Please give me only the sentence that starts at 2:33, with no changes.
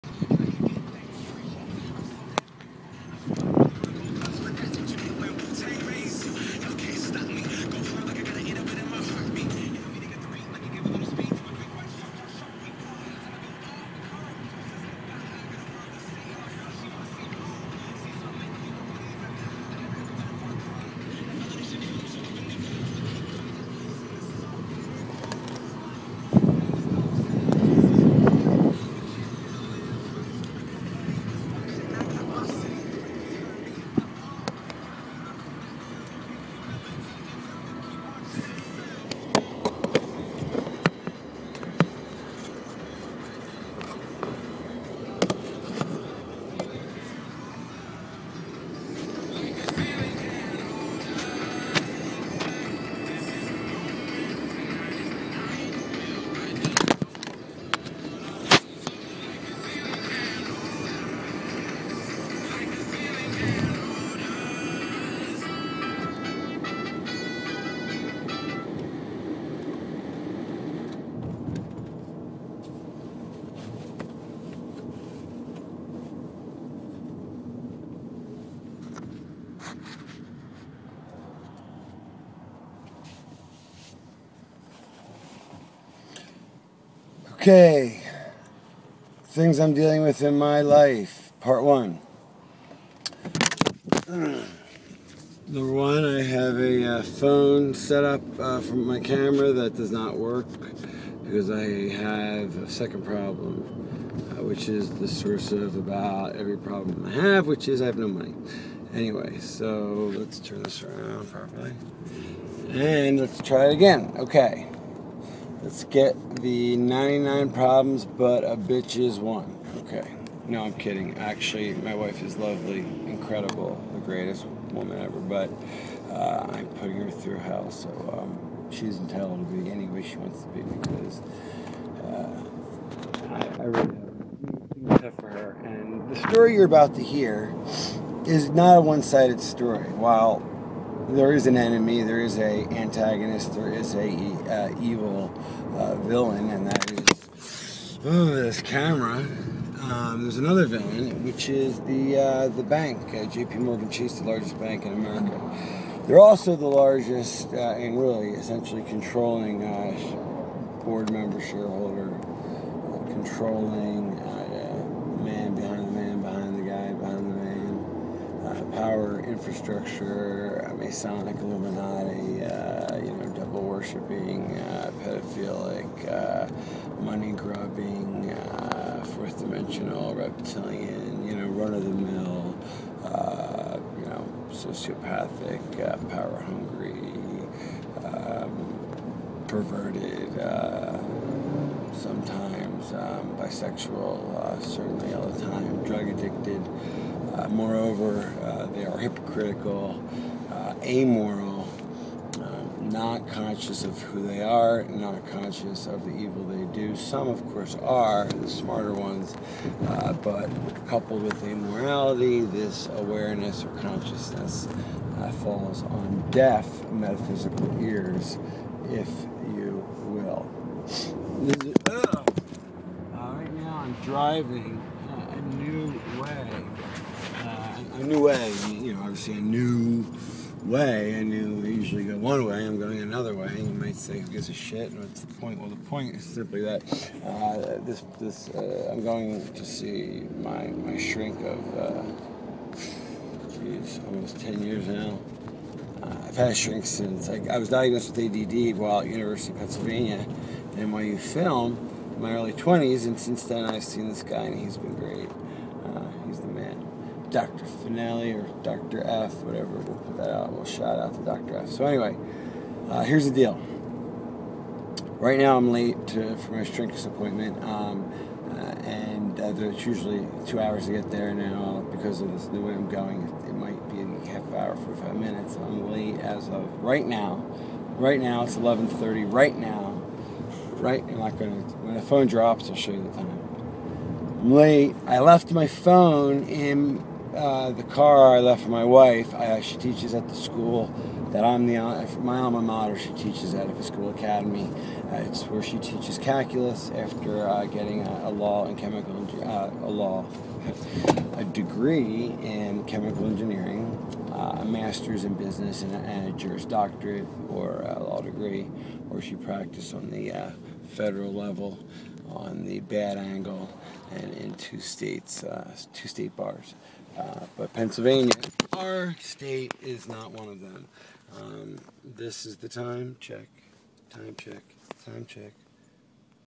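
Morgan Chase, the largest bank in America.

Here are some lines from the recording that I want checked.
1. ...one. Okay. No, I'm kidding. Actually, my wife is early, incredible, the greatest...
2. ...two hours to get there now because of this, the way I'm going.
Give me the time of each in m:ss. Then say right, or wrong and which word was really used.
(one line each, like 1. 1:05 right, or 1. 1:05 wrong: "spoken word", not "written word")
1. 1:59 wrong: "lovely", not "early"
2. 4:30 right.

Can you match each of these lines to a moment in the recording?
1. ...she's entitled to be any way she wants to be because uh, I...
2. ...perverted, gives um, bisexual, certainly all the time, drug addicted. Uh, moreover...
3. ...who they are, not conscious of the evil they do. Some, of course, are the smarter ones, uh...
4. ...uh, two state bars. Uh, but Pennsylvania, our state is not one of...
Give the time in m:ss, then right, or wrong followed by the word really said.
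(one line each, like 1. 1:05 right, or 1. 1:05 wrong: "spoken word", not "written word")
1. 2:08 right
2. 3:09 wrong: "sometimes", not "gives"
3. 3:24 right
4. 5:15 right.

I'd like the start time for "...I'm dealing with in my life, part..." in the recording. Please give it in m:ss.
1:29.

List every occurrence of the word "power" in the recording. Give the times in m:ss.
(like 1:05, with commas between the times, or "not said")
2:48, 3:06.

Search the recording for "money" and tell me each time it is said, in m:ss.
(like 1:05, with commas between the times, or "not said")
1:48, 2:57.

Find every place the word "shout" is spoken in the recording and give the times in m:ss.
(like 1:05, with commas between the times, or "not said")
4:20.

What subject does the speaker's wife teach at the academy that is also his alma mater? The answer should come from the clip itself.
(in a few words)
Calculus.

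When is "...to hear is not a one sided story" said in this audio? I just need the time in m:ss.
2:16.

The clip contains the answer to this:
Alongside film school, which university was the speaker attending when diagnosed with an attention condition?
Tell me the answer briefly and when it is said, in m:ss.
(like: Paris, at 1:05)
University of Pennsylvania, at 4:09.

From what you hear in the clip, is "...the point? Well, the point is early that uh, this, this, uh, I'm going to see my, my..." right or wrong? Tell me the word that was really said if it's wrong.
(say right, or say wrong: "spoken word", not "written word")
wrong: "simply", not "early".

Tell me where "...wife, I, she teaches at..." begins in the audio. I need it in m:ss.
4:48.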